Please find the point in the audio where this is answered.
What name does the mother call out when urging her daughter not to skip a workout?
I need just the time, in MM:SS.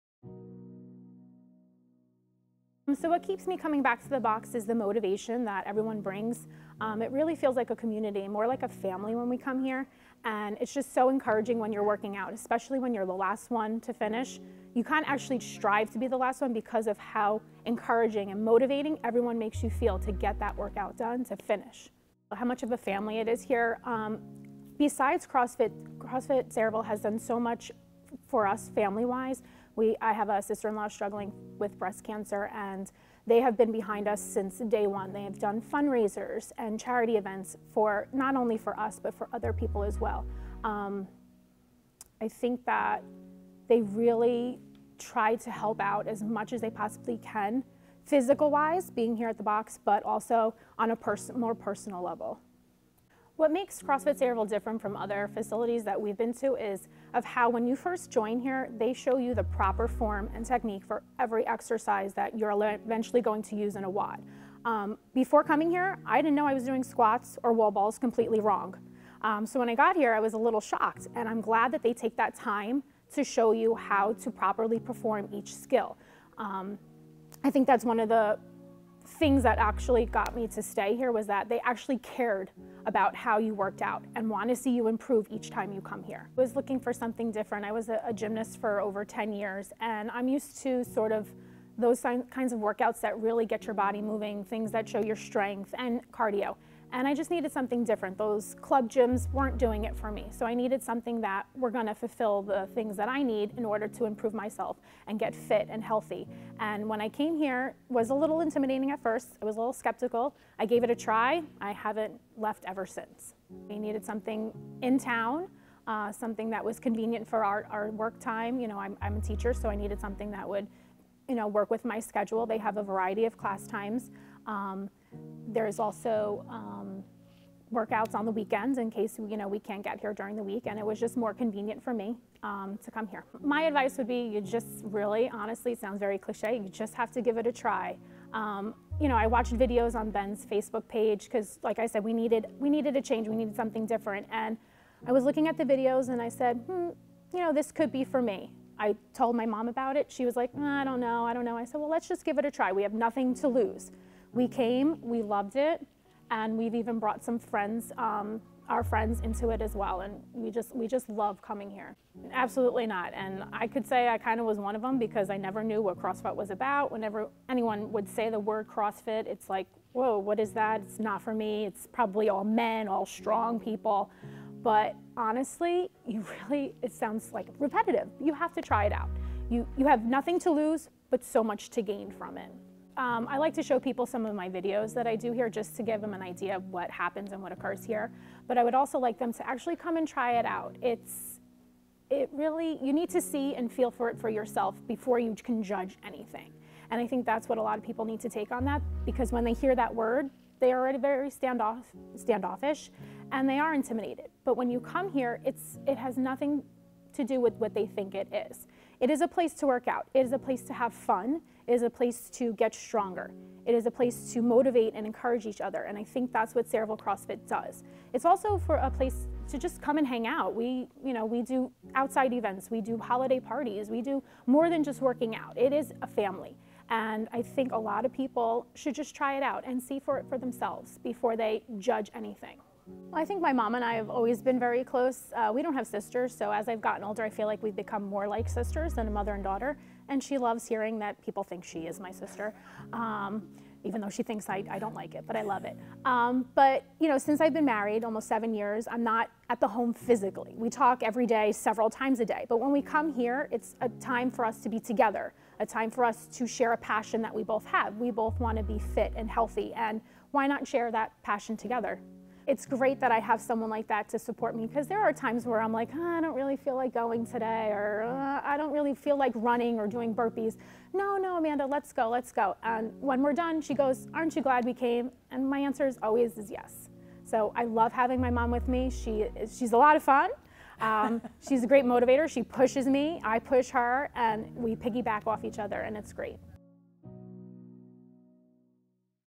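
04:31.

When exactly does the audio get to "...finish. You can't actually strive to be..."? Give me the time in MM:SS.
00:13.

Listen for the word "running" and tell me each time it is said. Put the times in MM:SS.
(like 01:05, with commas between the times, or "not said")
04:29.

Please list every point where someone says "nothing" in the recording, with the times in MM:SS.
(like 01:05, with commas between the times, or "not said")
02:32, 03:00, 03:26.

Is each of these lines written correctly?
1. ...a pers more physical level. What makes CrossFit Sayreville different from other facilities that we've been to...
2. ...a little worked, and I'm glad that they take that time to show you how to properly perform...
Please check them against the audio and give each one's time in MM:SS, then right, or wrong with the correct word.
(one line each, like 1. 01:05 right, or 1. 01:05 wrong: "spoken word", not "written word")
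1. 00:50 wrong: "personal", not "physical"
2. 01:10 wrong: "shocked", not "worked".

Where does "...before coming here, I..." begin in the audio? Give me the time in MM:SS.
01:05.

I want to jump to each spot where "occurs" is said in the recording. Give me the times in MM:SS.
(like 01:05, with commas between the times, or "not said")
03:07.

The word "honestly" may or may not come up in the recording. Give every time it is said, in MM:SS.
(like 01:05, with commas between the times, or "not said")
02:15, 02:55.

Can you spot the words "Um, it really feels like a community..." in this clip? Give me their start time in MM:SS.
00:06.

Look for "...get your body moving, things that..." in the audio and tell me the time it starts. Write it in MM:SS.
01:33.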